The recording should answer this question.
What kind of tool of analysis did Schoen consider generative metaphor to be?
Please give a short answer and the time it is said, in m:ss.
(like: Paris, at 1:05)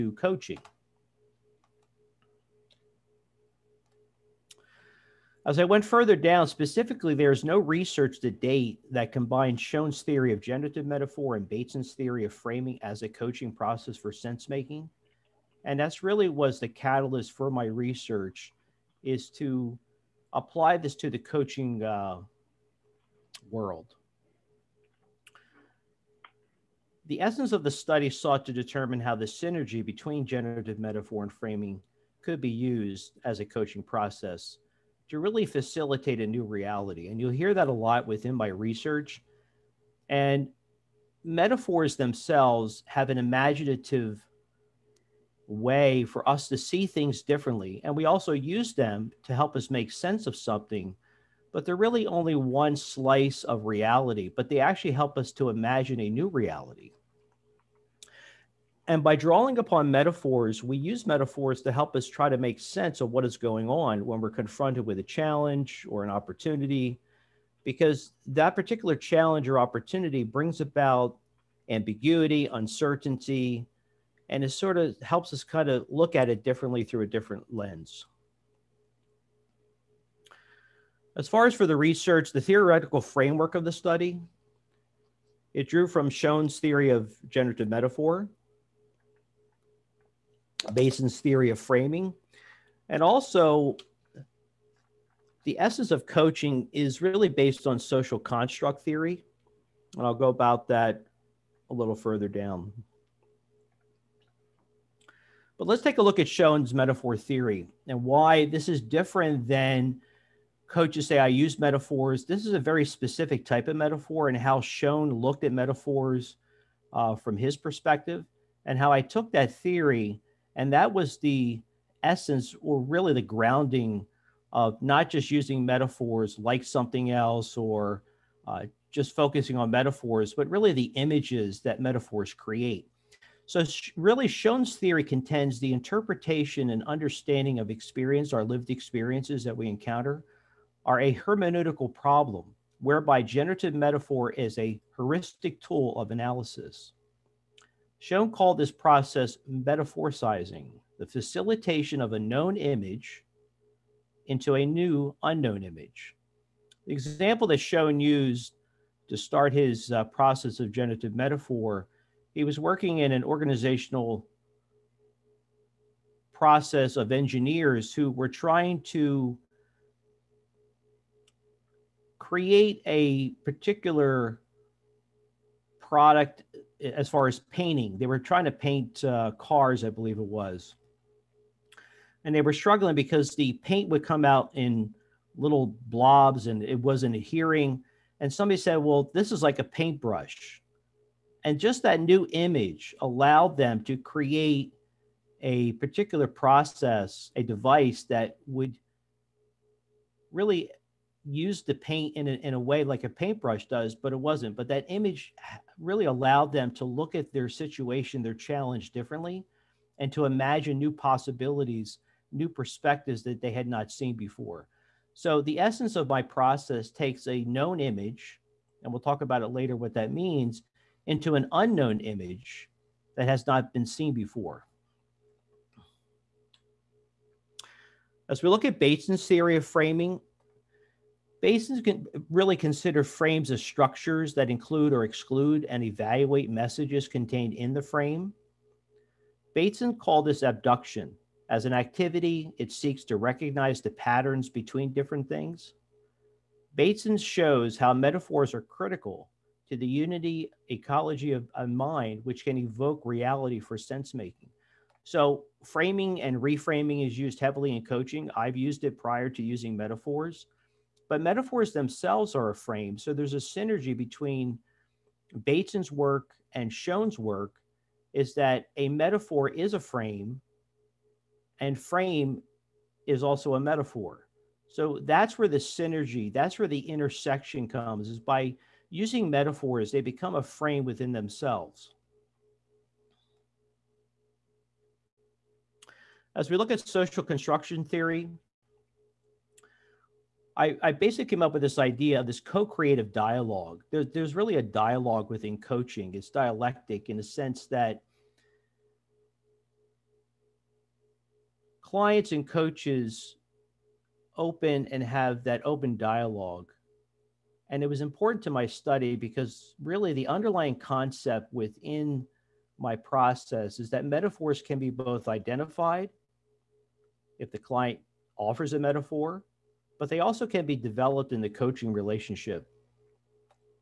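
heuristic, at 2:24.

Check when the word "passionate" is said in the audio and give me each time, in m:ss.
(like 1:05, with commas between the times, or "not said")
not said.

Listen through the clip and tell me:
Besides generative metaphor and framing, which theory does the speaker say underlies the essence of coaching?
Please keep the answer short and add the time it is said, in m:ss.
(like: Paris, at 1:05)
social construct theory, at 1:37.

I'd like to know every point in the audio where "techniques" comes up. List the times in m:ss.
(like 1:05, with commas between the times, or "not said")
not said.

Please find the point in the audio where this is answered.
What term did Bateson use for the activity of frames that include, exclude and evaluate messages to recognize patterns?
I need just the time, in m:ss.
4:00.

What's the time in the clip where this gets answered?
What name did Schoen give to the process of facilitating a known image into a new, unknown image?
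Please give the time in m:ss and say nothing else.
2:29.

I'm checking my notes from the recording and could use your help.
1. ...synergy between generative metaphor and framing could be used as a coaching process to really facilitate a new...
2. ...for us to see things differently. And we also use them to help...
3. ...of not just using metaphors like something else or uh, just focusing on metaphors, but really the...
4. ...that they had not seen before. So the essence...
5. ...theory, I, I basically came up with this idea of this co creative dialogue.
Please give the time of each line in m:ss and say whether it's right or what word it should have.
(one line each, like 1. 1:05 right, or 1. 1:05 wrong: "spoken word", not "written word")
1. 0:29 right
2. 0:46 right
3. 2:04 right
4. 3:33 right
5. 4:47 right.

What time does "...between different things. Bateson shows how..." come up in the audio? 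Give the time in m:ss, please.
4:04.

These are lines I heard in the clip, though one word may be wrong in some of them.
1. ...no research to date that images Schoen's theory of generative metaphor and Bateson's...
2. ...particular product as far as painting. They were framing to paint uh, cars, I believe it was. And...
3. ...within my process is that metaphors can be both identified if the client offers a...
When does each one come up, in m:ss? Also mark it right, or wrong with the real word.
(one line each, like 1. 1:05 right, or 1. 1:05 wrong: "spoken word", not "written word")
1. 0:07 wrong: "combines", not "images"
2. 2:53 wrong: "trying", not "framing"
3. 5:11 right.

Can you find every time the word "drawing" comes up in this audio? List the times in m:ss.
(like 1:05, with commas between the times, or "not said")
0:59.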